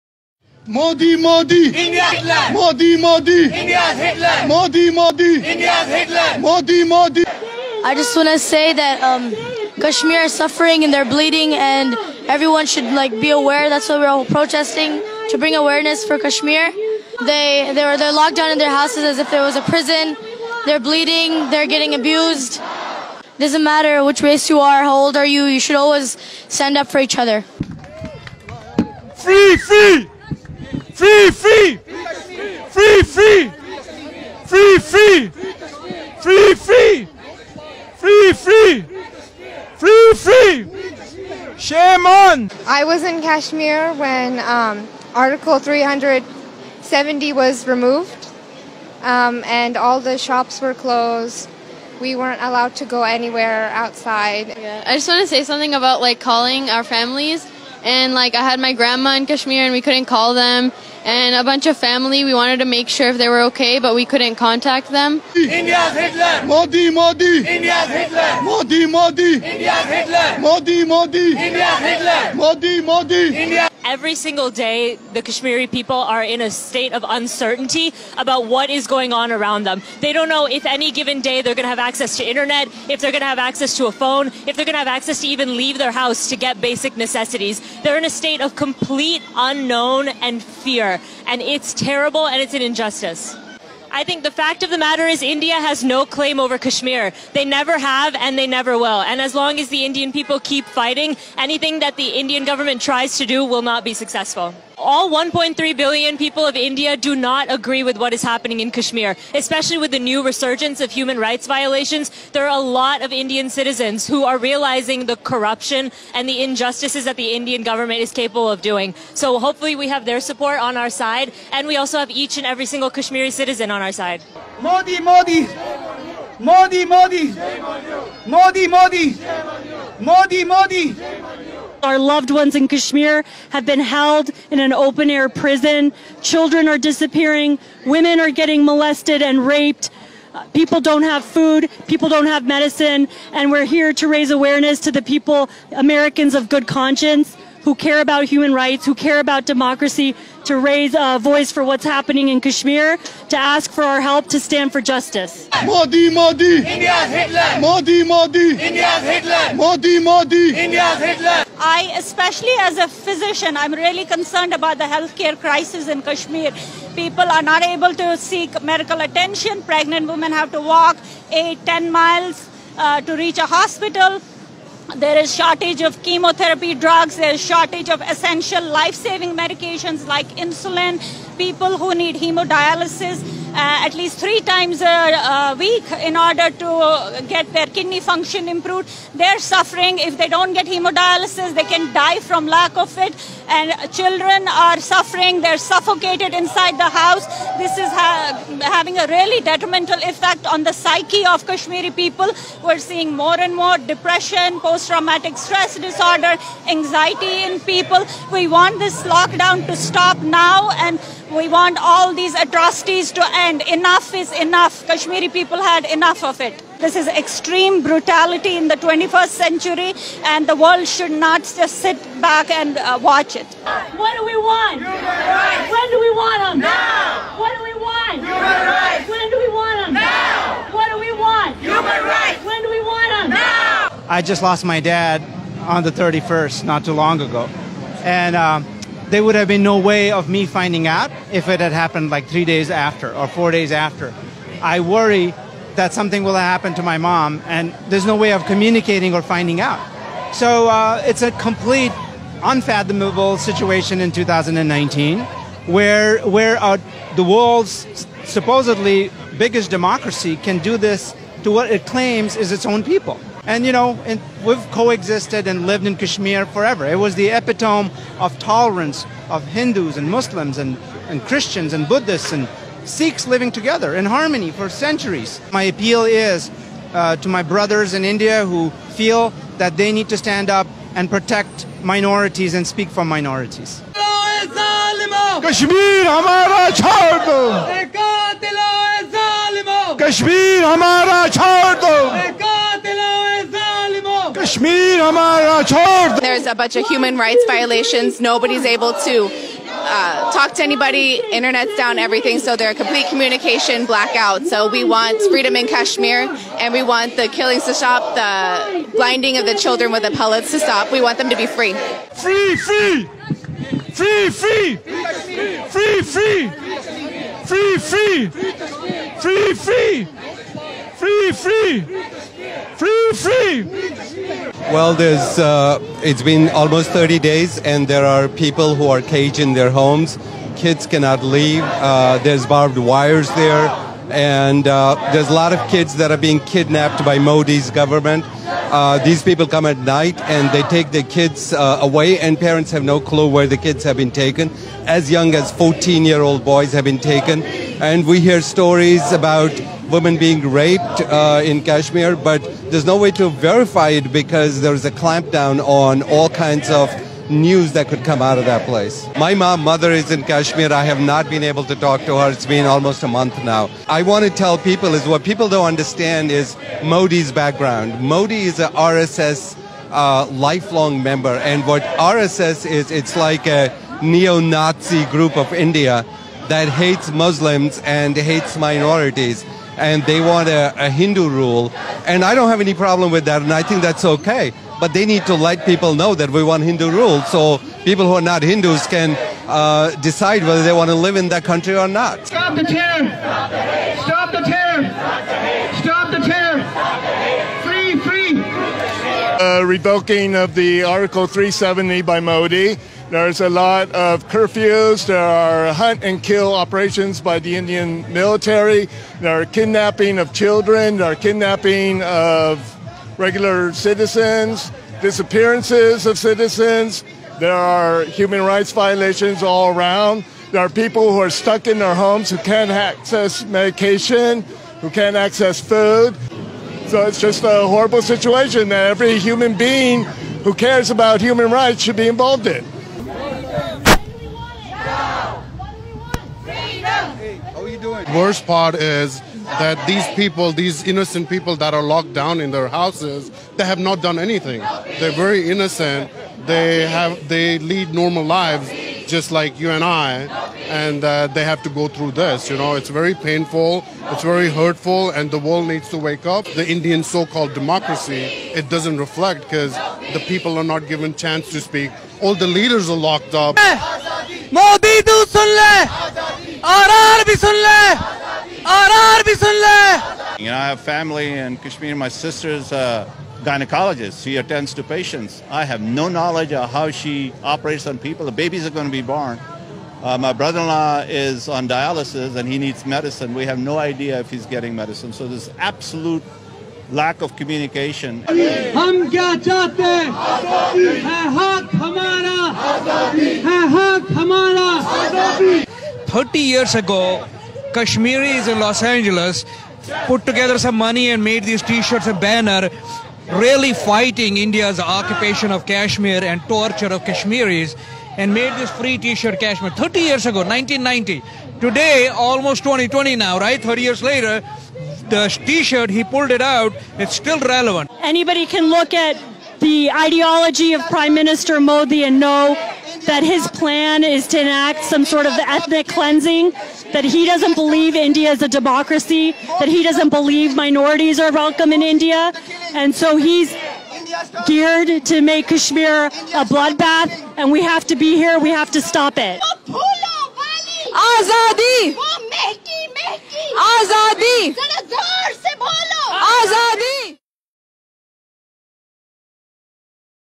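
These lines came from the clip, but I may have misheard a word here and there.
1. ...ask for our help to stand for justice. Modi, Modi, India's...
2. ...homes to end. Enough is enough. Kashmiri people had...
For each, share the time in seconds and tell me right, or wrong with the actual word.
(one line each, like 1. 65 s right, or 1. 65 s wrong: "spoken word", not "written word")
1. 153 s right
2. 212 s wrong: "atrocities", not "homes".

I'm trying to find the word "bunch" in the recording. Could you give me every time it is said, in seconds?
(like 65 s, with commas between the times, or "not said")
61 s, 296 s.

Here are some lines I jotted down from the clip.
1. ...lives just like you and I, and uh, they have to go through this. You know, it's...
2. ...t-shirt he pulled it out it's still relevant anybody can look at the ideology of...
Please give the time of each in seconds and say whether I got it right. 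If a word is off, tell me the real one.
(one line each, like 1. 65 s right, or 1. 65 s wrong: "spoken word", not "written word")
1. 448 s right
2. 515 s right.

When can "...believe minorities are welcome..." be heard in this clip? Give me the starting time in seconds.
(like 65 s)
530 s.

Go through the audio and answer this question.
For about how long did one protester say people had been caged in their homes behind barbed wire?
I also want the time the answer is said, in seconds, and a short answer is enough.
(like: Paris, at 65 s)
30 days, at 326 s.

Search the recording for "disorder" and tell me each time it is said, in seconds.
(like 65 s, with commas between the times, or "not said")
205 s.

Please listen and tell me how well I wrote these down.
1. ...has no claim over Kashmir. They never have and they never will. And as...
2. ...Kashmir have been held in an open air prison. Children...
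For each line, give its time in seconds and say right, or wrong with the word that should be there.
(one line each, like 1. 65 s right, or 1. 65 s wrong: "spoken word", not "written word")
1. 95 s right
2. 132 s right.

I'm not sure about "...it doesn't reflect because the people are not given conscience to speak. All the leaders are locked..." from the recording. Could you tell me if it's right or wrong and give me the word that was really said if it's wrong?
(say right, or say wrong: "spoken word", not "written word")
wrong: "chance", not "conscience".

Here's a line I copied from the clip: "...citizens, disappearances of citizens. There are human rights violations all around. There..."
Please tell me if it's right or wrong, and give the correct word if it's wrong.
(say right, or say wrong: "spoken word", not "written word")
right.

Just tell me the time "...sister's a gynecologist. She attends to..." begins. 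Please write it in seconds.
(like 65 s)
472 s.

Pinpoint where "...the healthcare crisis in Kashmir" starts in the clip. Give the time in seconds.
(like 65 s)
164 s.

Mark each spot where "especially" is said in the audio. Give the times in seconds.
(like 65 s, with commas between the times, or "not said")
109 s, 161 s.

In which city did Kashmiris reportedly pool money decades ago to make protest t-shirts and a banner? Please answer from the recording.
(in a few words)
Los Angeles.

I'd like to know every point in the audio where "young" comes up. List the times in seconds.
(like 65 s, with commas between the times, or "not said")
345 s.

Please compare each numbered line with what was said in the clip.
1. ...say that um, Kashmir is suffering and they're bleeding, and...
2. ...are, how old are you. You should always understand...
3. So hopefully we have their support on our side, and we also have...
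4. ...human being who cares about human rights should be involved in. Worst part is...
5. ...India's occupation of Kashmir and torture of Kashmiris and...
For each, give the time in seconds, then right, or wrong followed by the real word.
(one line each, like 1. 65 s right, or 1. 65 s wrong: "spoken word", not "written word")
1. 8 s right
2. 24 s wrong: "stand", not "understand"
3. 119 s right
4. 429 s right
5. 504 s right.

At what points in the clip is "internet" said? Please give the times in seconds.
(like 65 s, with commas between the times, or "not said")
82 s, 301 s.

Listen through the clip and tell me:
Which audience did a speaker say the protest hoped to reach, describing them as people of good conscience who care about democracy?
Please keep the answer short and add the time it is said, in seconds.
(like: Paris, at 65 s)
Americans, at 145 s.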